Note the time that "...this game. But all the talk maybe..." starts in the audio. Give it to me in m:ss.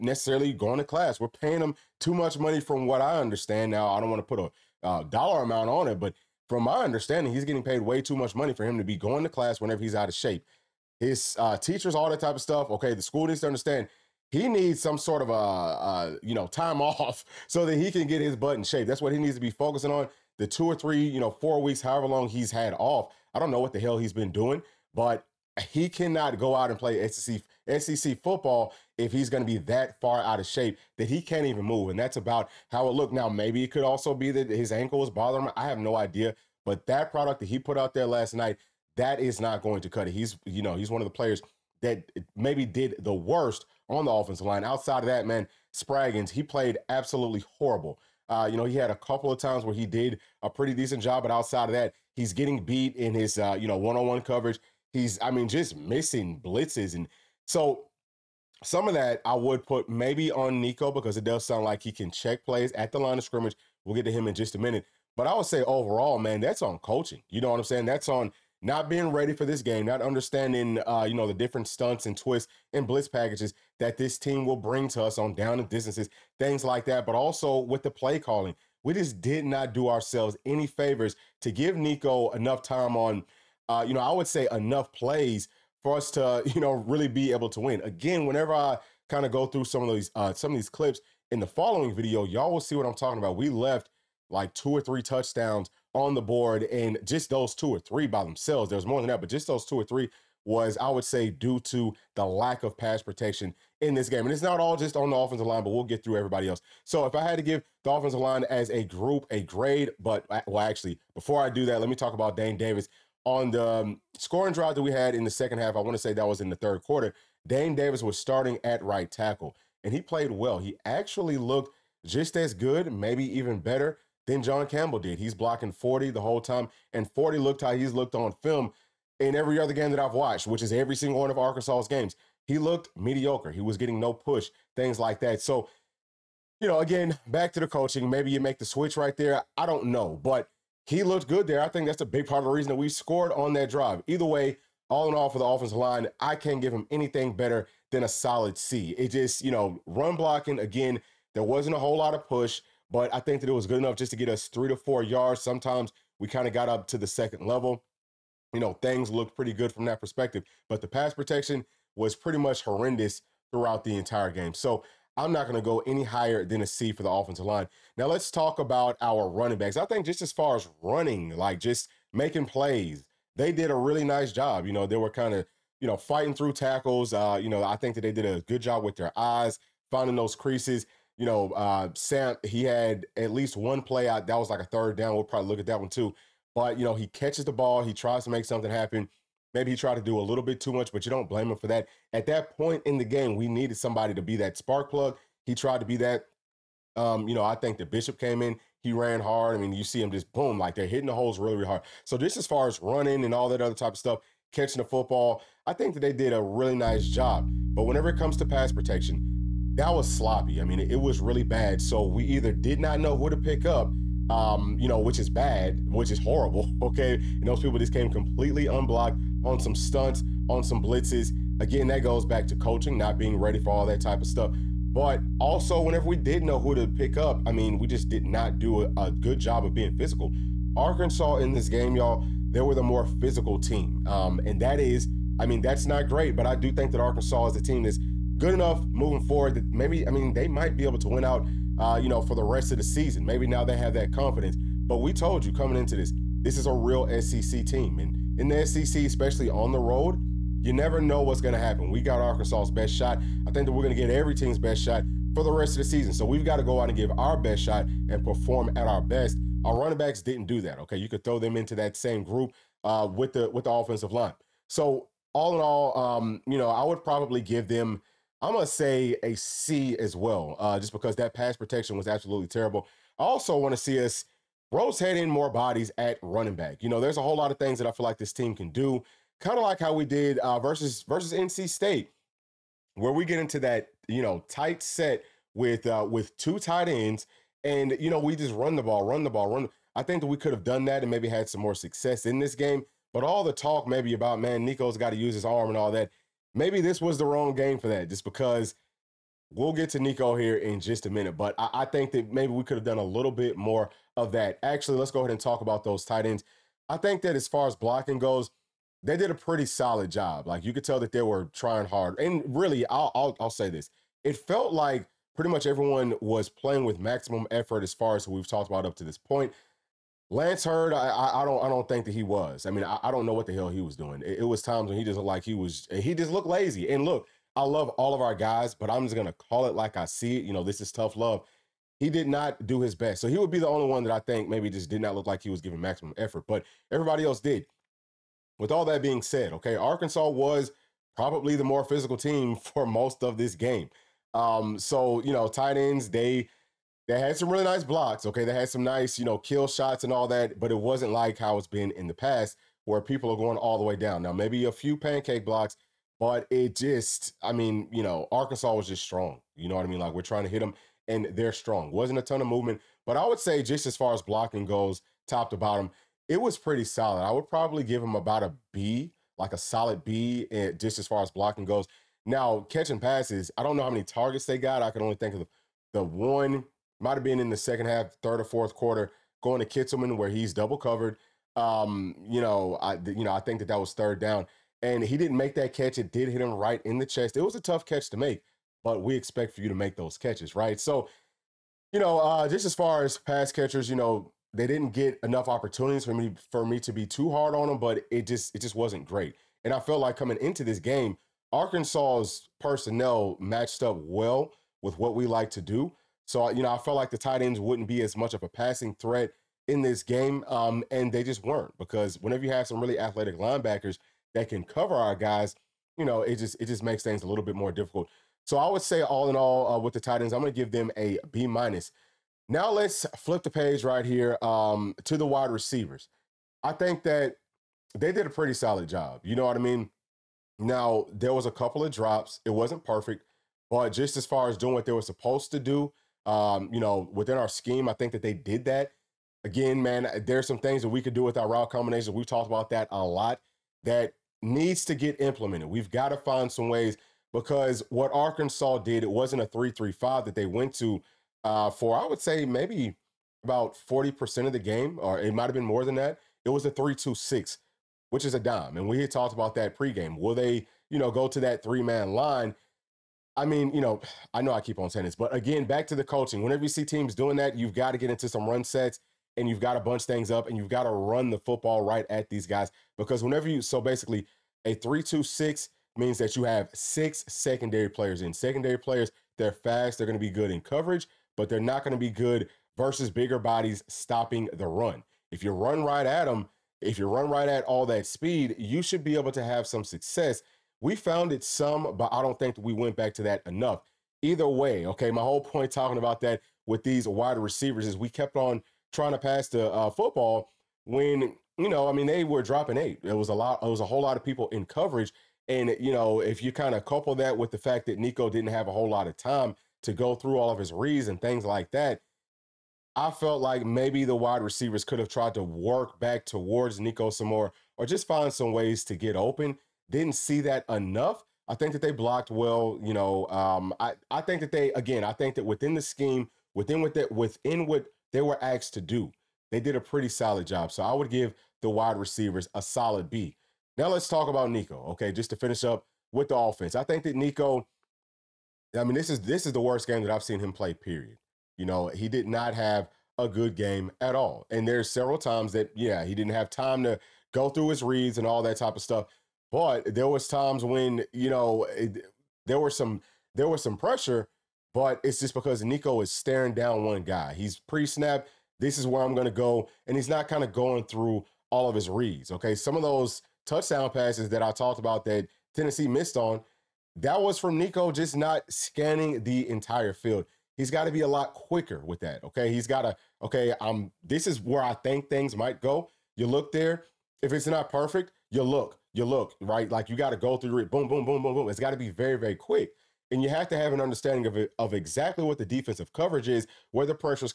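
4:52.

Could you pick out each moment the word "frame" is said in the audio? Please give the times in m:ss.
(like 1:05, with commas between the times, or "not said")
not said.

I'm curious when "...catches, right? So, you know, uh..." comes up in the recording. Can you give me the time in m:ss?
6:30.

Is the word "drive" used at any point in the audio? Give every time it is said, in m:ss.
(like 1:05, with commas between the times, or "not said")
1:54, 2:23.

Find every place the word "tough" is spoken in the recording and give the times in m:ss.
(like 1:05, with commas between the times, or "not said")
5:30, 6:27.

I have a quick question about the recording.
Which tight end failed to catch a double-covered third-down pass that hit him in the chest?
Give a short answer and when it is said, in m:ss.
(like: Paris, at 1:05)
Kitselman, at 6:19.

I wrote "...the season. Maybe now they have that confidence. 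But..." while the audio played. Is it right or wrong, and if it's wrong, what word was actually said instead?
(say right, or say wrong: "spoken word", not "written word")
right.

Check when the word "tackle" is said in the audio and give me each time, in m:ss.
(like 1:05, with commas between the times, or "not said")
1:59, 2:56.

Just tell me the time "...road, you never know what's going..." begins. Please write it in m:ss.
4:09.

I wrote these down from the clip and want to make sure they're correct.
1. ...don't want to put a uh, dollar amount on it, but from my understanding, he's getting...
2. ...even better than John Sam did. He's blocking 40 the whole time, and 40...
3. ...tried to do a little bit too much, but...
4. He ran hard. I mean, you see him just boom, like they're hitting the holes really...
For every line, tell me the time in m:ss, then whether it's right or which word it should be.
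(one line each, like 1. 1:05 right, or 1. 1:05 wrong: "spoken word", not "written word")
1. 0:03 right
2. 2:03 wrong: "Campbell", not "Sam"
3. 3:09 right
4. 3:18 right.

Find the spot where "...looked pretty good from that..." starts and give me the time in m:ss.
2:39.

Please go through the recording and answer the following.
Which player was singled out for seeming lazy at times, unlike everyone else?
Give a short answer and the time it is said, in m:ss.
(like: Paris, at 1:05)
Lance Heard, at 5:20.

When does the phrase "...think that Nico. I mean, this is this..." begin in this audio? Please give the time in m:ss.
8:56.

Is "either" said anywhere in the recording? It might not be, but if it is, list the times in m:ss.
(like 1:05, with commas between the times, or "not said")
2:24, 3:32, 8:14.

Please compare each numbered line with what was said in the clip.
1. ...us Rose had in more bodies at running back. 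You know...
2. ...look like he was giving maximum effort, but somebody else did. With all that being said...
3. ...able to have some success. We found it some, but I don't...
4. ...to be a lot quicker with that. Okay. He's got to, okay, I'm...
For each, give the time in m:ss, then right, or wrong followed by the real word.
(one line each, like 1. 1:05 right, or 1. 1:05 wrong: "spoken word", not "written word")
1. 4:34 right
2. 5:35 wrong: "everybody", not "somebody"
3. 8:09 right
4. 9:30 right.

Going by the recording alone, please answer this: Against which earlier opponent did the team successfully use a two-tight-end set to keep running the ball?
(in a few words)
NC State.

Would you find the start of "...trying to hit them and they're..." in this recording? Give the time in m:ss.
6:00.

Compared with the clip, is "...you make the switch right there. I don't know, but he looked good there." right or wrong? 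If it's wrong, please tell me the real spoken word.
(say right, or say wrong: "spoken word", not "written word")
right.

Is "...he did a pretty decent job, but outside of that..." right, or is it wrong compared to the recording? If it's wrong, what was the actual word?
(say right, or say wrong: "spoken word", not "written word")
right.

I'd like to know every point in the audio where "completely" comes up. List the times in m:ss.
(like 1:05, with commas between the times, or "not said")
3:38.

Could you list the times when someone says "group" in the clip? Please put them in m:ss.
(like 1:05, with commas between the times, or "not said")
1:48, 4:22.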